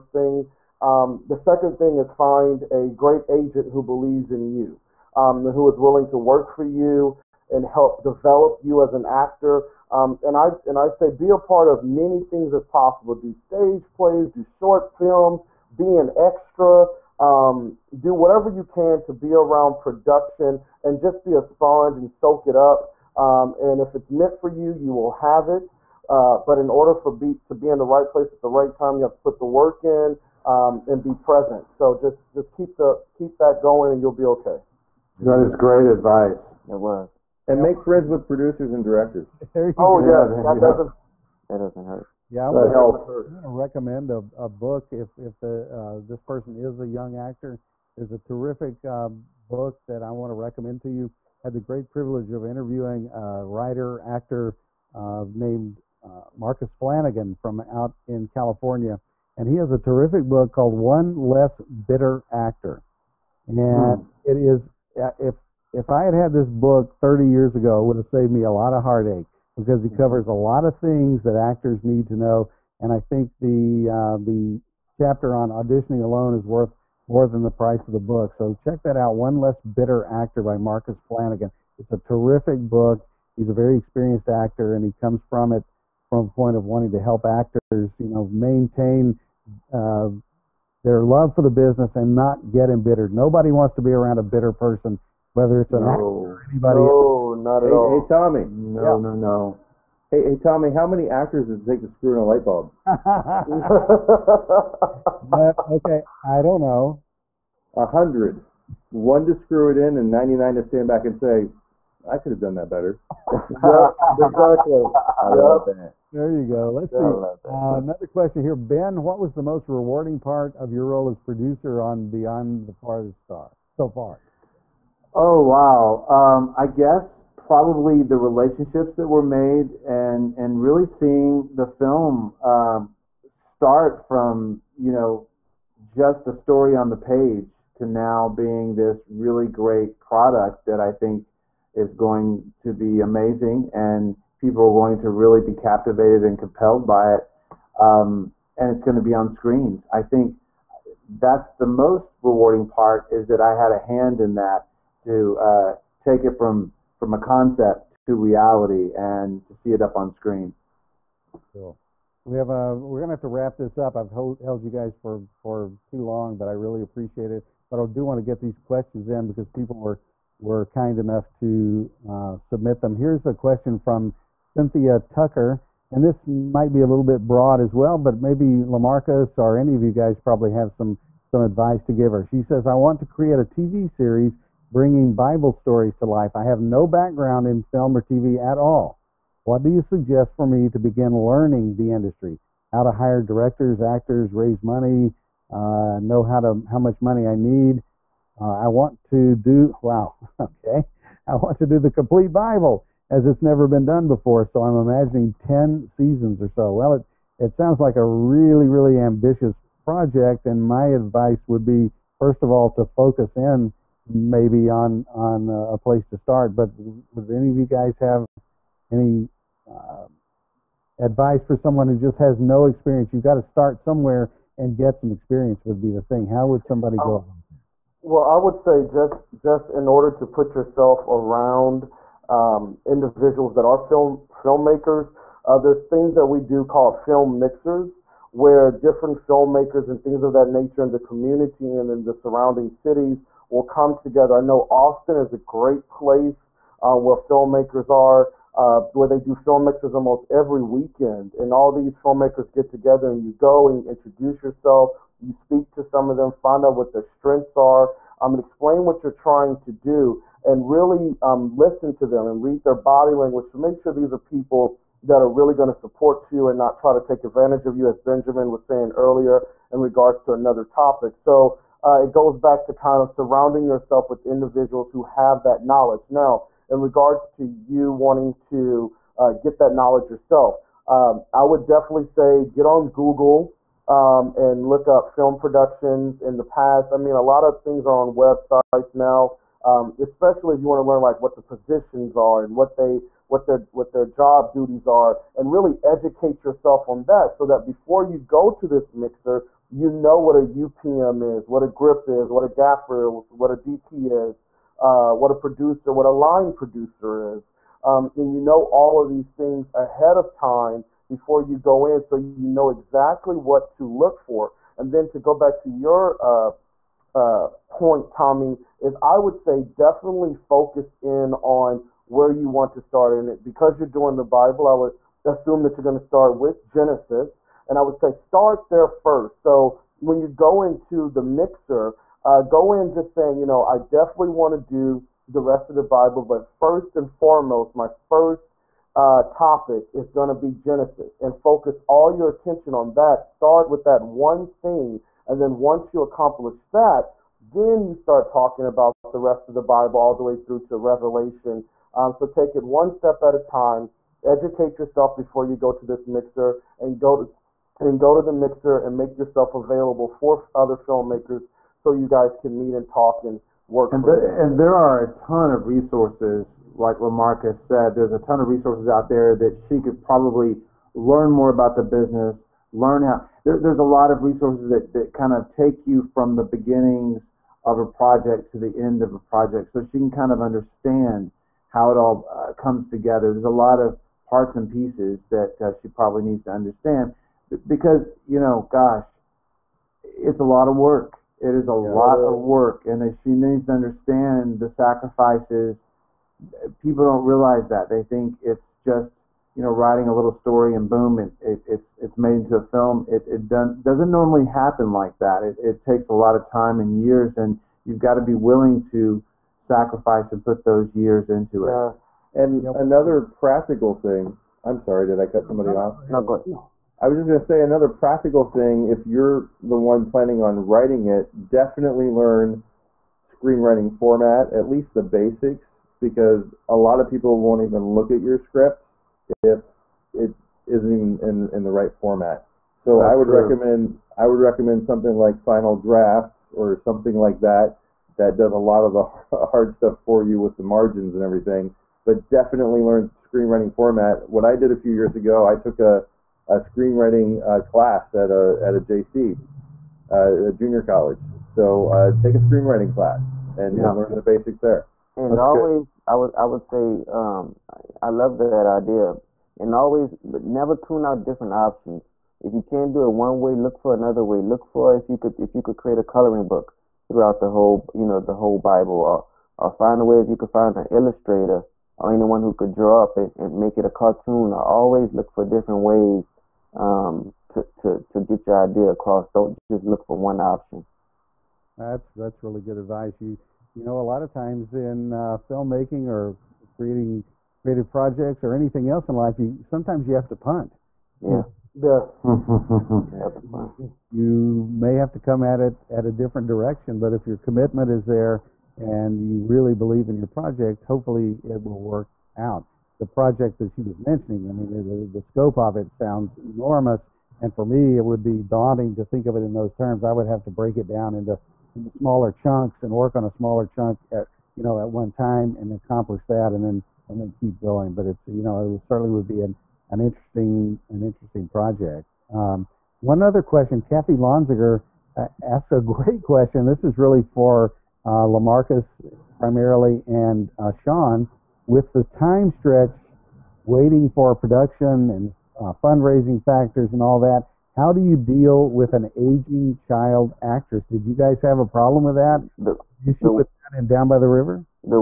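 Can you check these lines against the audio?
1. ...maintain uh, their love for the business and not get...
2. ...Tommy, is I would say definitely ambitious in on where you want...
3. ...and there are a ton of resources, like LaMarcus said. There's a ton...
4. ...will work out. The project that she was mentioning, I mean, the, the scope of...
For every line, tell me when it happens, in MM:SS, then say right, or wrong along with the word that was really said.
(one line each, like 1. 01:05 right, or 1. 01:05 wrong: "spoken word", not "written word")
1. 01:28 right
2. 05:18 wrong: "focus", not "ambitious"
3. 06:04 right
4. 08:21 right.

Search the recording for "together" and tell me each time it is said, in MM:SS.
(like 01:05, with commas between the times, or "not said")
04:03, 04:12, 06:22.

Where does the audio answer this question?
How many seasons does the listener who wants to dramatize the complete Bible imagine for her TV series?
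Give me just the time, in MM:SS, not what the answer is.
03:25.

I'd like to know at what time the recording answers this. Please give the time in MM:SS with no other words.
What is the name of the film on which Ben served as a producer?
02:02.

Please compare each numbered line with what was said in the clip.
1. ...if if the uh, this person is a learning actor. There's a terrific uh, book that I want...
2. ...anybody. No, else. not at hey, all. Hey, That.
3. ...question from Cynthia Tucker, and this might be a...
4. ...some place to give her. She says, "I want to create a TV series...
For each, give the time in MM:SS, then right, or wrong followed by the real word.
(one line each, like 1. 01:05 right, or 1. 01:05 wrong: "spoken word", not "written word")
1. 00:44 wrong: "young", not "learning"
2. 01:36 wrong: "Tommy", not "That"
3. 02:53 right
4. 03:01 wrong: "advice", not "place".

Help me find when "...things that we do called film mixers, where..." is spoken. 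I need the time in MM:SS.
03:55.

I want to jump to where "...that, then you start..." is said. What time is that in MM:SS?
05:46.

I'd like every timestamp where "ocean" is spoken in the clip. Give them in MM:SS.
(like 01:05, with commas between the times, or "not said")
not said.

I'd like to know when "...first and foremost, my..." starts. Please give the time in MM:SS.
05:36.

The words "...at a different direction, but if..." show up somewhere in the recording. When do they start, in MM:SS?
08:15.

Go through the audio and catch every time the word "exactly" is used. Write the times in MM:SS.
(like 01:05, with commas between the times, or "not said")
01:54, 05:12.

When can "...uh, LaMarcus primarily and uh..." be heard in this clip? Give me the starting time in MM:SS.
08:48.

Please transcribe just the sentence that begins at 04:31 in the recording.
So uh, it goes back to kind of surrounding yourself with individuals who have that knowledge.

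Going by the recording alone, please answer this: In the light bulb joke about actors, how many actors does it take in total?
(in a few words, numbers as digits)
100.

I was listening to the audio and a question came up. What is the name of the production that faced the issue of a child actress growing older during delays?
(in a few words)
Down by the River.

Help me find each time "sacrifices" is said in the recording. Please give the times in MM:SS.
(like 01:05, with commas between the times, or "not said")
06:34, 06:49.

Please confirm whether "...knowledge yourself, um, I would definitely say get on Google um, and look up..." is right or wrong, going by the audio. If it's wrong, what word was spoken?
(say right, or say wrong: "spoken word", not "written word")
right.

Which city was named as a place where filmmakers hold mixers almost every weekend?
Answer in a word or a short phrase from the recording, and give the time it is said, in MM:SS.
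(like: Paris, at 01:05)
Austin, at 04:04.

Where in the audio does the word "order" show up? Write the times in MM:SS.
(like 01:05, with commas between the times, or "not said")
00:26, 03:49.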